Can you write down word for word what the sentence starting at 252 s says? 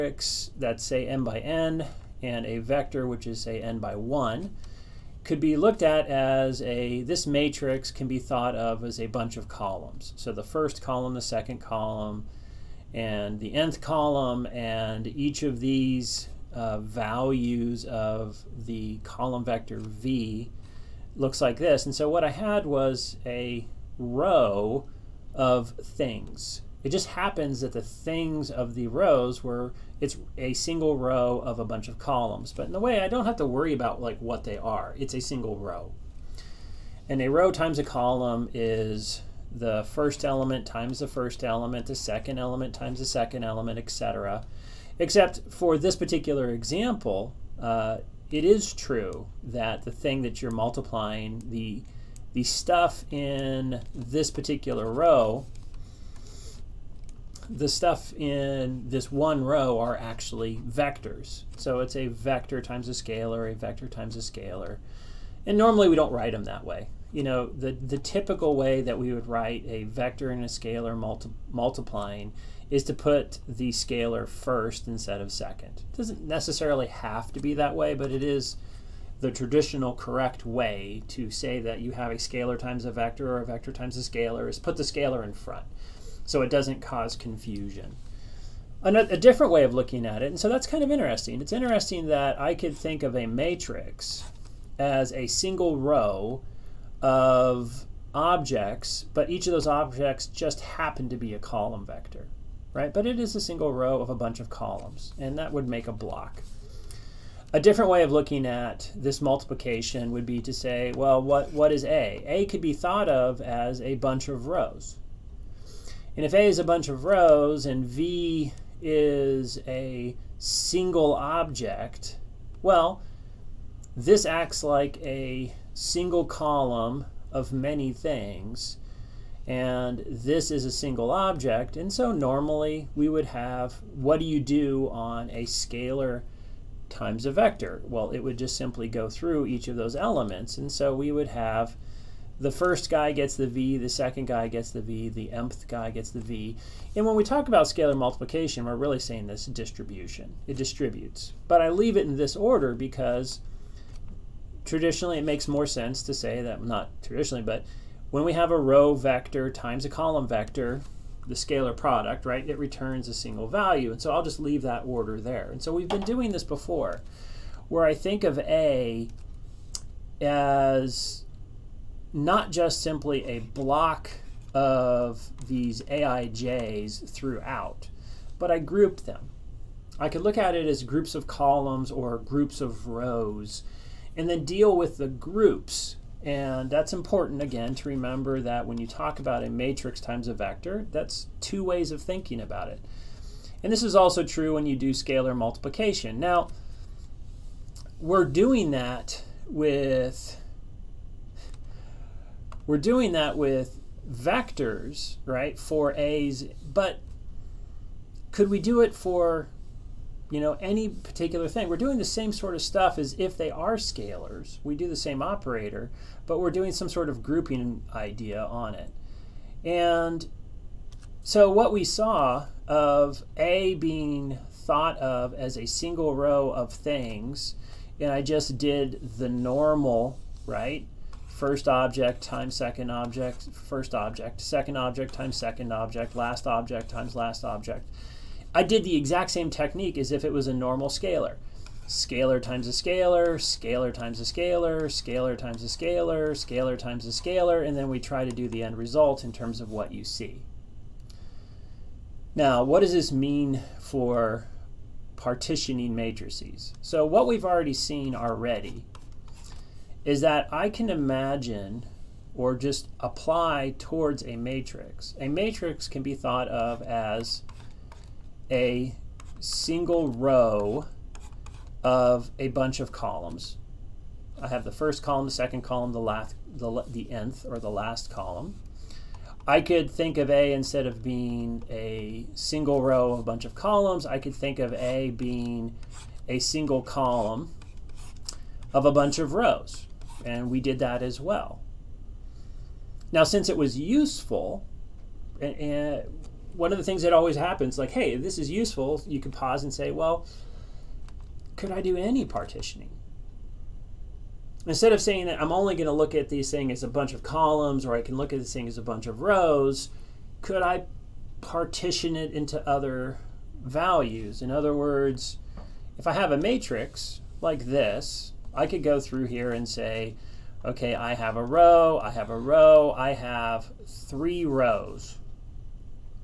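Now, what does this mean for partitioning matrices?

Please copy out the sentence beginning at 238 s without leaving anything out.
I did the exact same technique as if it was a normal scalar.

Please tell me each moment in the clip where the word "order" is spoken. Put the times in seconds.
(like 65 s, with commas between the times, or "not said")
152 s, 164 s.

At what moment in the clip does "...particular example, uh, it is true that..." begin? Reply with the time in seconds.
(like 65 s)
45 s.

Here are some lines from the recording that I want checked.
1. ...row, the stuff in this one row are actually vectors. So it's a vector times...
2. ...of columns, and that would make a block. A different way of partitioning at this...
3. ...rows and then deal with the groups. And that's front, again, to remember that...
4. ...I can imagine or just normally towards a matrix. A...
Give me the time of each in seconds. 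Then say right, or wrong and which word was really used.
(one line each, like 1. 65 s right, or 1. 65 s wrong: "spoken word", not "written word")
1. 54 s right
2. 104 s wrong: "looking", not "partitioning"
3. 182 s wrong: "important", not "front"
4. 260 s wrong: "apply", not "normally".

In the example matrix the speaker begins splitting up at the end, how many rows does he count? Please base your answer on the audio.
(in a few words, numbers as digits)
3.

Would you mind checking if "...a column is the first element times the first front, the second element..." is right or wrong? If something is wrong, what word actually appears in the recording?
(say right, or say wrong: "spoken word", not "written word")
wrong: "element", not "front".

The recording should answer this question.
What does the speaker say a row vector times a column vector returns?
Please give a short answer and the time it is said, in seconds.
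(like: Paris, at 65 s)
A single value, at 163 s.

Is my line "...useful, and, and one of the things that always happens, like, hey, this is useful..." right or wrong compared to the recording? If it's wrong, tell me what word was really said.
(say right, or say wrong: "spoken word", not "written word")
right.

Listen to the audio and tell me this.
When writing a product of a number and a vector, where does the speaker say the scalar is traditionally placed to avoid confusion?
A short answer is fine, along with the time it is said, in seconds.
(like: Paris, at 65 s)
In front, at 84 s.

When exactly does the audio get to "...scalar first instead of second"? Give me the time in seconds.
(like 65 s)
73 s.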